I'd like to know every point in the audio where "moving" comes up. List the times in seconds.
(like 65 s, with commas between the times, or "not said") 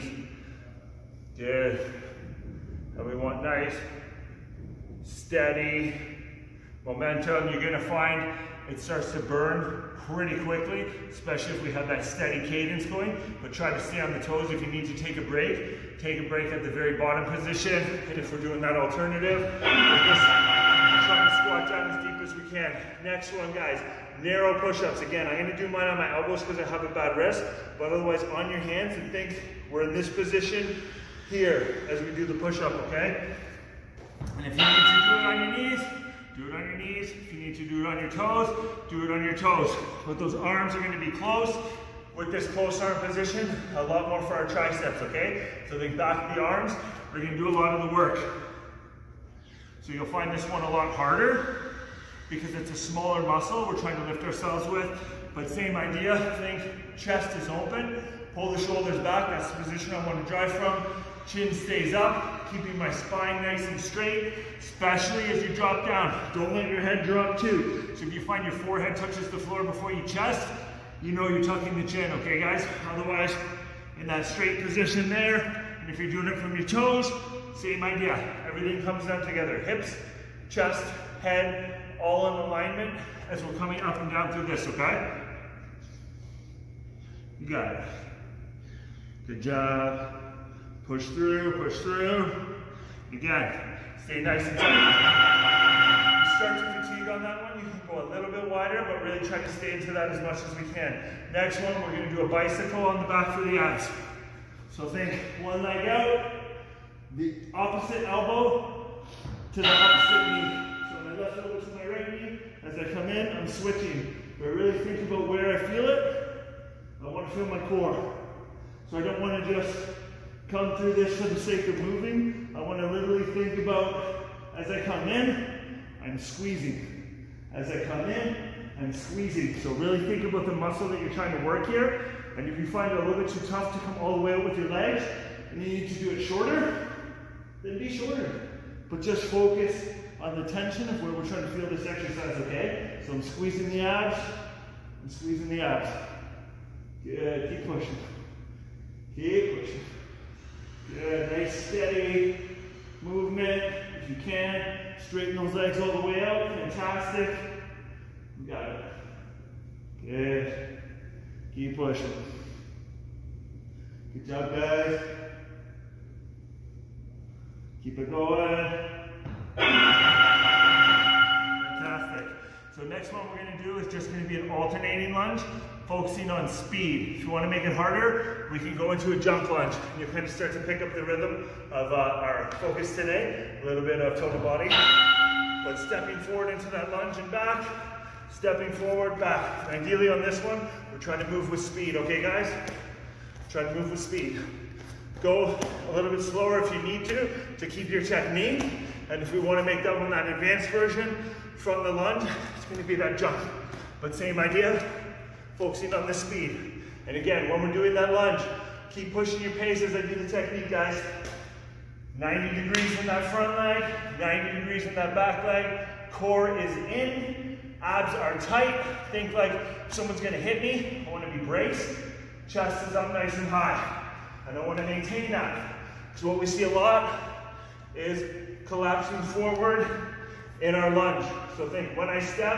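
121 s.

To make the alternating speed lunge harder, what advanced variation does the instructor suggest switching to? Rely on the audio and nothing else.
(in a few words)
Jump lunge.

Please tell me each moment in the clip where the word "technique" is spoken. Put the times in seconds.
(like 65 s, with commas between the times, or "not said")
198 s, 210 s.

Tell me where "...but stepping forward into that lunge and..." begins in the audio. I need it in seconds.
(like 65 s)
184 s.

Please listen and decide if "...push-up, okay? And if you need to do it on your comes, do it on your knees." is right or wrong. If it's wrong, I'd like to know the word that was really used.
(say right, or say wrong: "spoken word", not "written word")
wrong: "knees", not "comes".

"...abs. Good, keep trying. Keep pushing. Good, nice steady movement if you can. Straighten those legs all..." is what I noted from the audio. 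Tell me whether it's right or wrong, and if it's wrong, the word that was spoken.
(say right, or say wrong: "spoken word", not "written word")
wrong: "pushing", not "trying".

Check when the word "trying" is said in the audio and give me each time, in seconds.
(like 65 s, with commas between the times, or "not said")
53 s, 131 s, 141 s, 190 s.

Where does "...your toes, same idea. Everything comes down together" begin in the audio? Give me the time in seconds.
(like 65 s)
76 s.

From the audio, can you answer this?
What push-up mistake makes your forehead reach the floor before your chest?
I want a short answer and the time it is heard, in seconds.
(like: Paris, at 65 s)
Tucking the chin, at 71 s.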